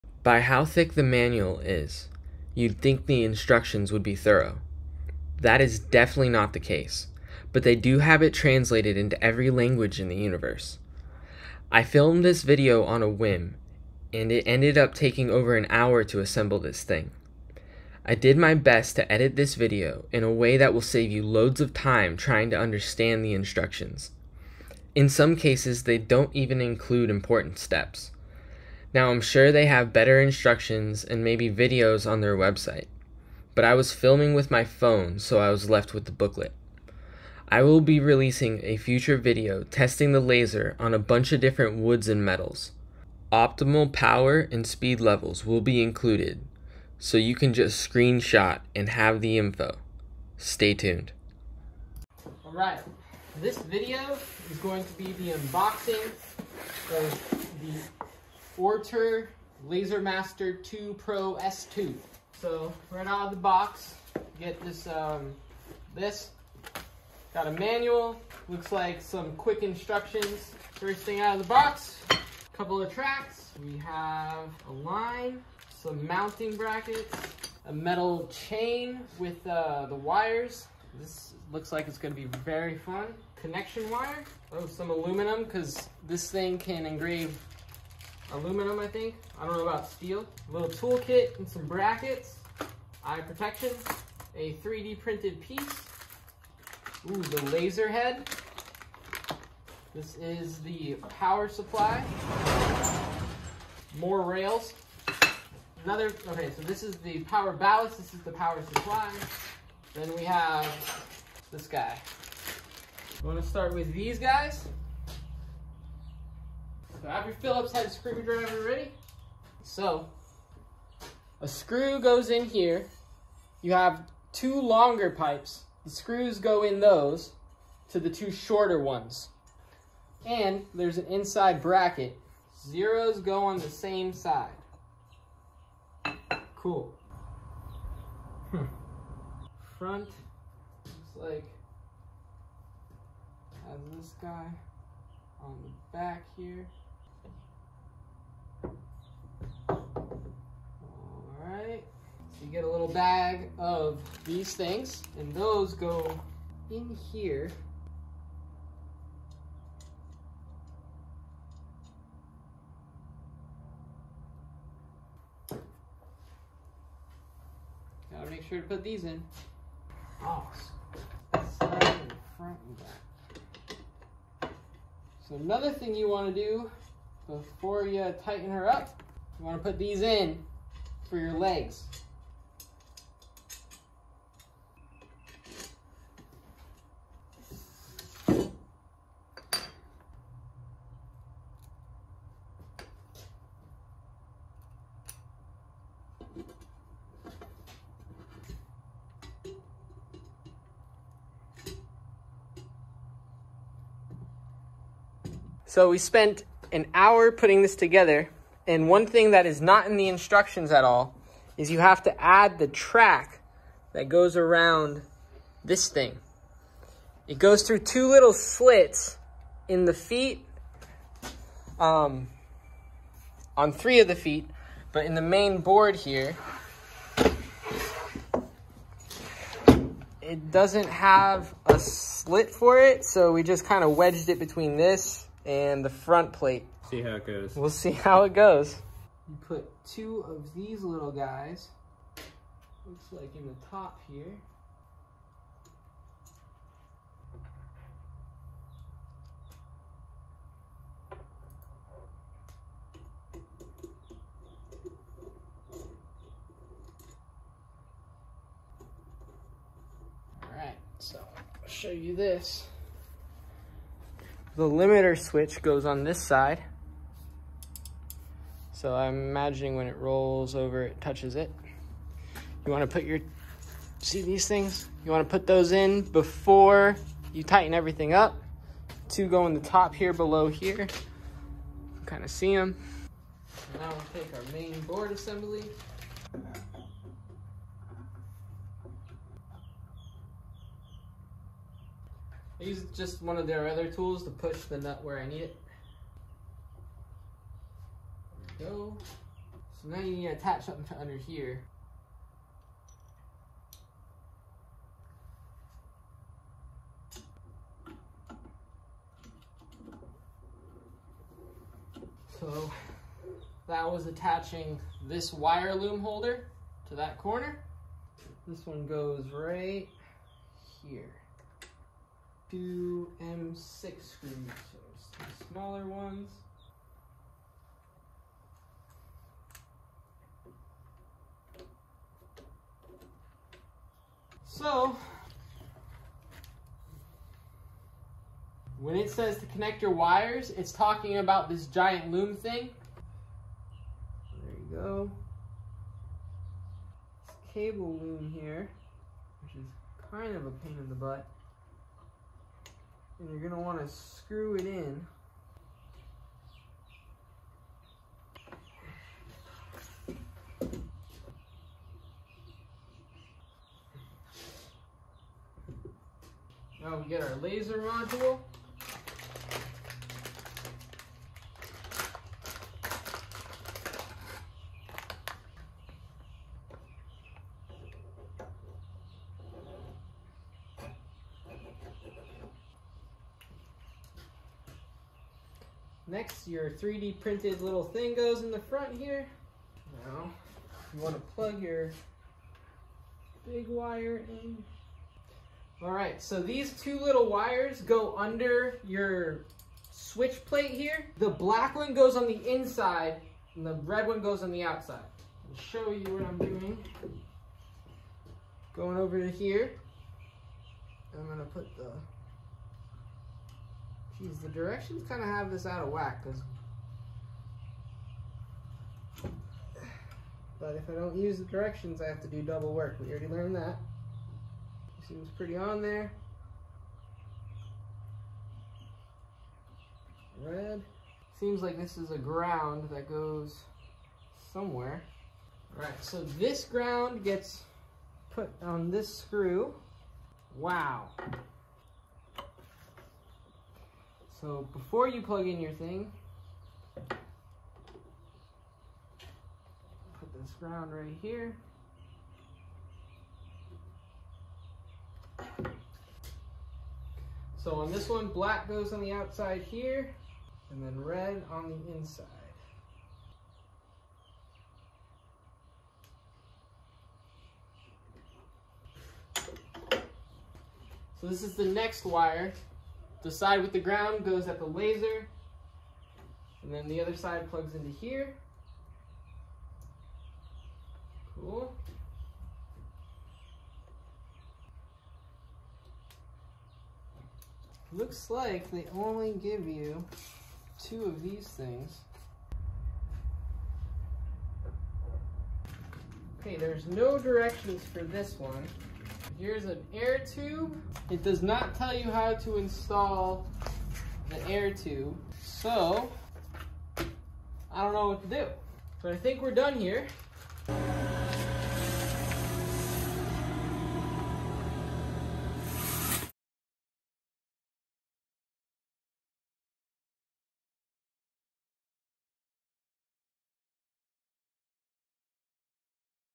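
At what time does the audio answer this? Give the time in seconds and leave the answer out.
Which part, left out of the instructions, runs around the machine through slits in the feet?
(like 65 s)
212 s.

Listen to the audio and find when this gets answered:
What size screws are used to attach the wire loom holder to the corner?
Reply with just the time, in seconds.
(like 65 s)
323 s.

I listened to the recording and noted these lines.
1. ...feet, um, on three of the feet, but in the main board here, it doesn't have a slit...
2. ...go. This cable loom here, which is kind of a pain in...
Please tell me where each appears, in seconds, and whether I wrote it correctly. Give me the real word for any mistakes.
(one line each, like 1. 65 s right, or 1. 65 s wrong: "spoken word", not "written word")
1. 219 s right
2. 344 s right.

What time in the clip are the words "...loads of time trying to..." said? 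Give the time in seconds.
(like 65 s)
21 s.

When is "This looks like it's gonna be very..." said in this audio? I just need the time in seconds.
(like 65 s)
80 s.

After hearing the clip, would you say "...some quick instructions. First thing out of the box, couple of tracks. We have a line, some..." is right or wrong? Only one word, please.
right.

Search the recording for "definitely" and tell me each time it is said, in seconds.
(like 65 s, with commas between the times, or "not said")
5 s.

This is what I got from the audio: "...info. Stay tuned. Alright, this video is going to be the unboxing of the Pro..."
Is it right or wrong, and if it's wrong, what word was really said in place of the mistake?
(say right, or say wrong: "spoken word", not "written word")
wrong: "Laser", not "Pro".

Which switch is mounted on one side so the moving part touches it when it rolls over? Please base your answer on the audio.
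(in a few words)
limiter switch.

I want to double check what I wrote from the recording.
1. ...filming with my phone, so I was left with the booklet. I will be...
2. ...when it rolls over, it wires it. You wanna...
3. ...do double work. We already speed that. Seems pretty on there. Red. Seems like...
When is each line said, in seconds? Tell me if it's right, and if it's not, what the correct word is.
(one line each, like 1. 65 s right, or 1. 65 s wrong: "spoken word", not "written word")
1. 33 s right
2. 269 s wrong: "touches", not "wires"
3. 422 s wrong: "learned", not "speed".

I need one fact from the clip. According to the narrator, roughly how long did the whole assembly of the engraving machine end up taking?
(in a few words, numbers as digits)
over an hour.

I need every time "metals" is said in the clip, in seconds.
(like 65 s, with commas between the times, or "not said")
42 s, 77 s.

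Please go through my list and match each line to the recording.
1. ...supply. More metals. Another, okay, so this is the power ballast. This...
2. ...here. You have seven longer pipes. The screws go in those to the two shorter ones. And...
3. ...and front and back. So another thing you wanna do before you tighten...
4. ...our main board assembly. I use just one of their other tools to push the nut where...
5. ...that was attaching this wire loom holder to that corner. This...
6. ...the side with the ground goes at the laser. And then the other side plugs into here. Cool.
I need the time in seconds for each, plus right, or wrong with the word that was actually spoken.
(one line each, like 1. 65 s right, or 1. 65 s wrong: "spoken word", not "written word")
1. 101 s wrong: "rails", not "metals"
2. 122 s wrong: "two", not "seven"
3. 171 s right
4. 284 s right
5. 313 s right
6. 473 s right.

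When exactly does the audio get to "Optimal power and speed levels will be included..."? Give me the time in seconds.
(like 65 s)
43 s.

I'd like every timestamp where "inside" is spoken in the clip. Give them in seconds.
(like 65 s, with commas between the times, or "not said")
131 s, 402 s, 461 s.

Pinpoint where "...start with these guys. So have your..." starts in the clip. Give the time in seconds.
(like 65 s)
113 s.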